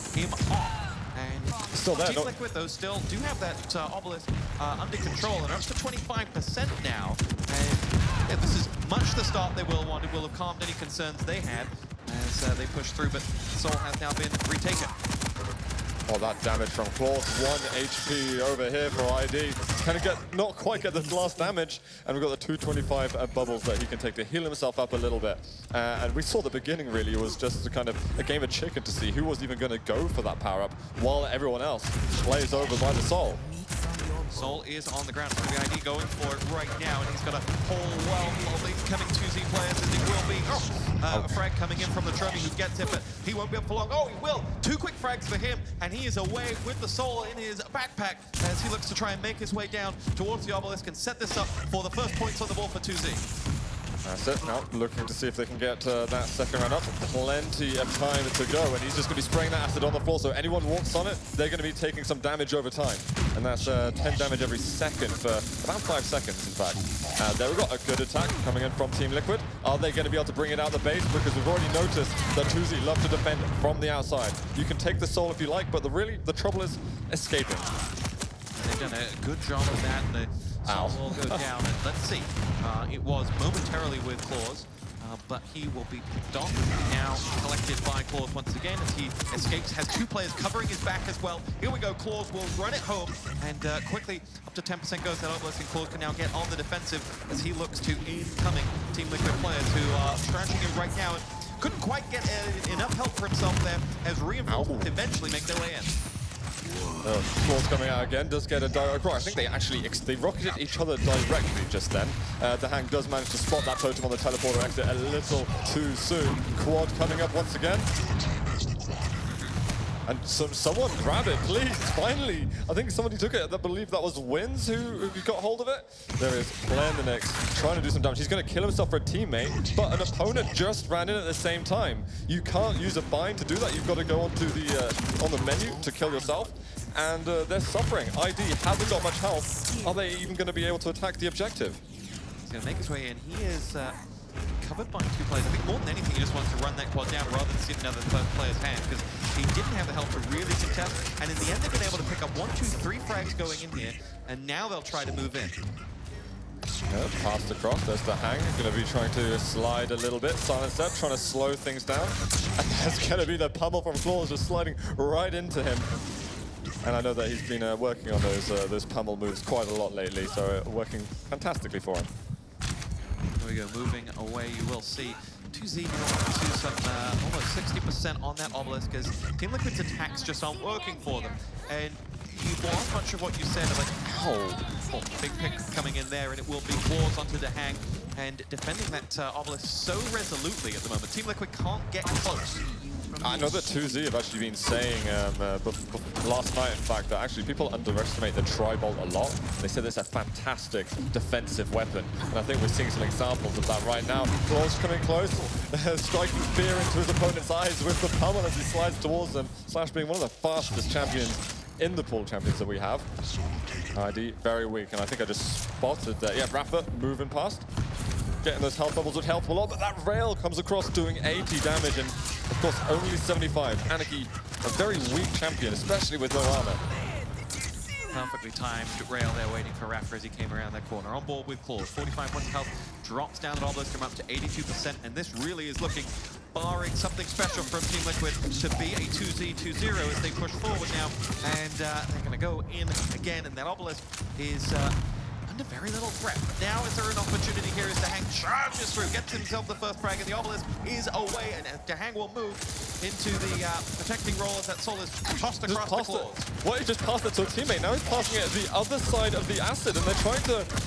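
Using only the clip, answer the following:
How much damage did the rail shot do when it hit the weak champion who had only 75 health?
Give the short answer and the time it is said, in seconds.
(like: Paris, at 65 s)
80, at 221 s.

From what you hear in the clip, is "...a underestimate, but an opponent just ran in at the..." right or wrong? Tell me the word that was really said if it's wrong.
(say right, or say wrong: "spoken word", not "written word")
wrong: "teammate", not "underestimate".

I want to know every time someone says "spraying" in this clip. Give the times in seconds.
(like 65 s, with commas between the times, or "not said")
59 s.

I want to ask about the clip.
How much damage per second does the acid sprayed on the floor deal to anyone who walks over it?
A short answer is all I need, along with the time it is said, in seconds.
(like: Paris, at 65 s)
10, at 63 s.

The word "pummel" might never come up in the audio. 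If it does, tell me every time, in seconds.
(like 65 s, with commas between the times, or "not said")
163 s, 168 s, 208 s.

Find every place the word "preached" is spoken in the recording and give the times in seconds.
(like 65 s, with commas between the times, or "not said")
not said.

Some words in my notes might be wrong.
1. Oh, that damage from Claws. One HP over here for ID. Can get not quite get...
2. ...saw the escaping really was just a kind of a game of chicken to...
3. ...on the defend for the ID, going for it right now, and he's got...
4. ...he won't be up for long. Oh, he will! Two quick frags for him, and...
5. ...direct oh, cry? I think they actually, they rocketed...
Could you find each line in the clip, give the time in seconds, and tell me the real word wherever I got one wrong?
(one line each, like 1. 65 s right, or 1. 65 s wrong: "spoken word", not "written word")
1. 16 s right
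2. 26 s wrong: "beginning", not "escaping"
3. 34 s wrong: "ground", not "defend"
4. 43 s right
5. 108 s right.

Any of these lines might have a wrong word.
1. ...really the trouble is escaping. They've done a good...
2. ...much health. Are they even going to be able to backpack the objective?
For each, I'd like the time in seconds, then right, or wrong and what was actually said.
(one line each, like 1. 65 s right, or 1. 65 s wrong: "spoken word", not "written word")
1. 75 s right
2. 139 s wrong: "attack", not "backpack".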